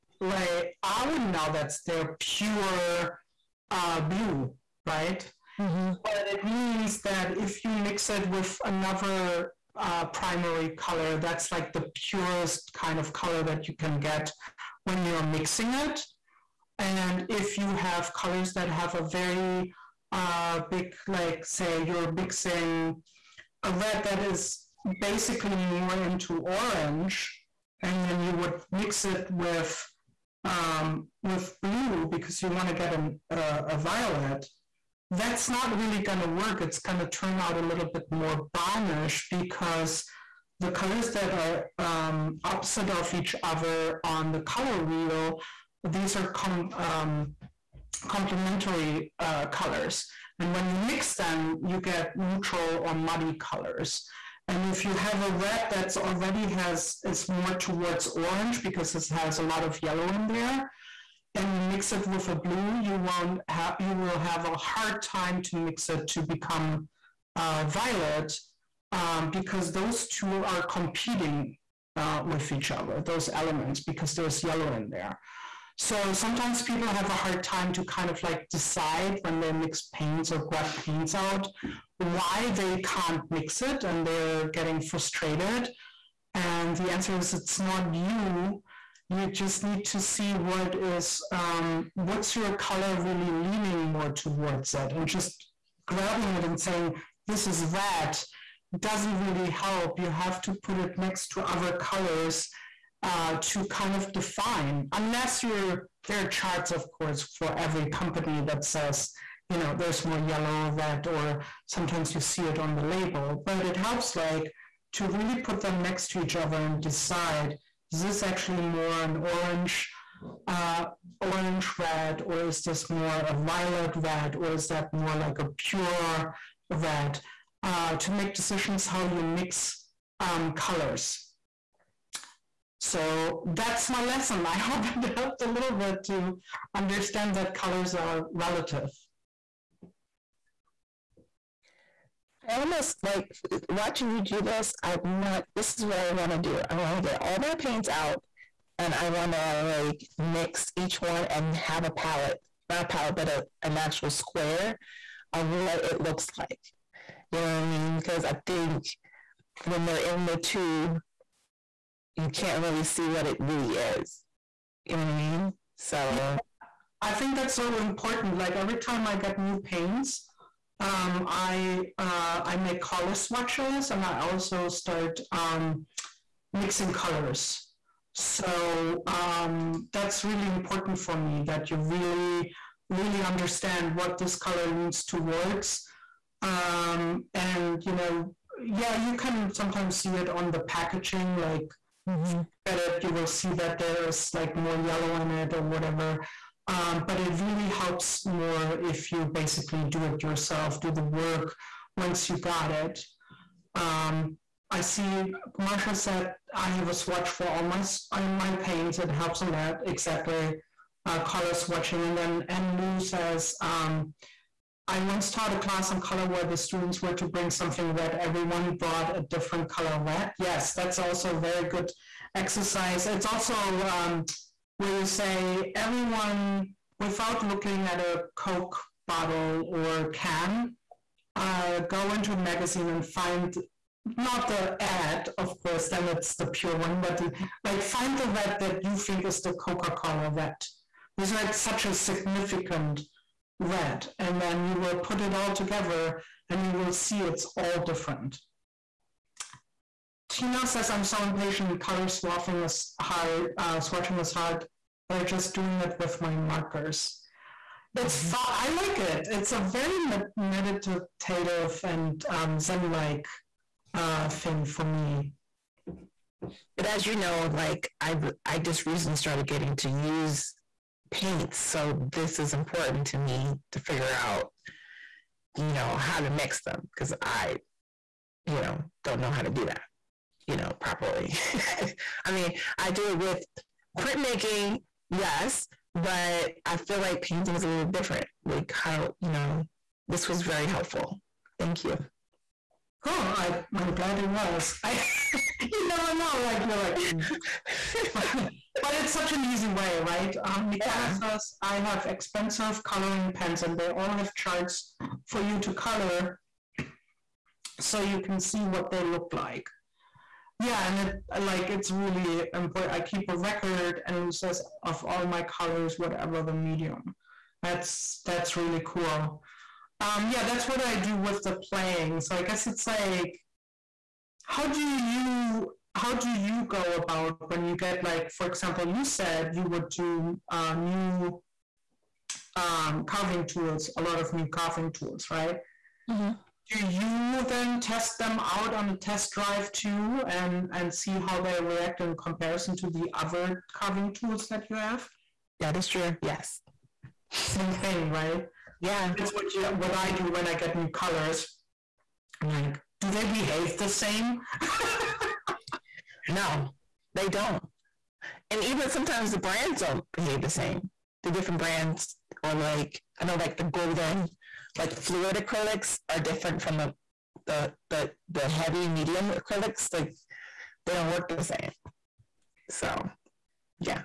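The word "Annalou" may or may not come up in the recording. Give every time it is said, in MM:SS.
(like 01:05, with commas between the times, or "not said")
03:32, 05:14.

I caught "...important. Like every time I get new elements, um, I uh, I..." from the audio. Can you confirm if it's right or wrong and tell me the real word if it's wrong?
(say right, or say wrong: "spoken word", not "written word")
wrong: "paints", not "elements".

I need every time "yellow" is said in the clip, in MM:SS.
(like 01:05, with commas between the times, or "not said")
00:59, 01:14, 01:50, 03:14.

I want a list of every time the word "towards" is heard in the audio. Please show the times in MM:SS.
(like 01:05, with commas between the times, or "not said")
00:57, 01:34, 03:05.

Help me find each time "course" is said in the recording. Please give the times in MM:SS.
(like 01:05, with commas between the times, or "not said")
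01:46, 03:55.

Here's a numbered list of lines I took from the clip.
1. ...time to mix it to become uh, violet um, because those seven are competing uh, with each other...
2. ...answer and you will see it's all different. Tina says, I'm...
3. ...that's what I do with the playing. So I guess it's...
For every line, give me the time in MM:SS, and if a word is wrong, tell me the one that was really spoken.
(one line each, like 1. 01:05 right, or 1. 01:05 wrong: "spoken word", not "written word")
1. 01:05 wrong: "two", not "seven"
2. 04:05 wrong: "together", not "answer"
3. 05:20 right.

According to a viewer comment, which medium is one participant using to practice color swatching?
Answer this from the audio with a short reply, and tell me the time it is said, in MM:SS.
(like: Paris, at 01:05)
markers, at 04:16.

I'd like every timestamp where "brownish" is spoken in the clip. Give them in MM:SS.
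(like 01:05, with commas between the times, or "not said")
00:38.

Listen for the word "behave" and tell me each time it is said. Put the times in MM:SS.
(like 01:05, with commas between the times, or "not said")
05:53, 06:00.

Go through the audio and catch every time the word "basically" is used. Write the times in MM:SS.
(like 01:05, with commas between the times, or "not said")
00:25, 03:19.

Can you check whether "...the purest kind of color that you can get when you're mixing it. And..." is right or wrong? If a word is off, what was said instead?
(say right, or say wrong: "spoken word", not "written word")
right.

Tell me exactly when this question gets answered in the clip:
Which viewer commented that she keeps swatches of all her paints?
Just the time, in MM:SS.
03:25.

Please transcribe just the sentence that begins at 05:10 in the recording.
Yeah, and it like it's really important.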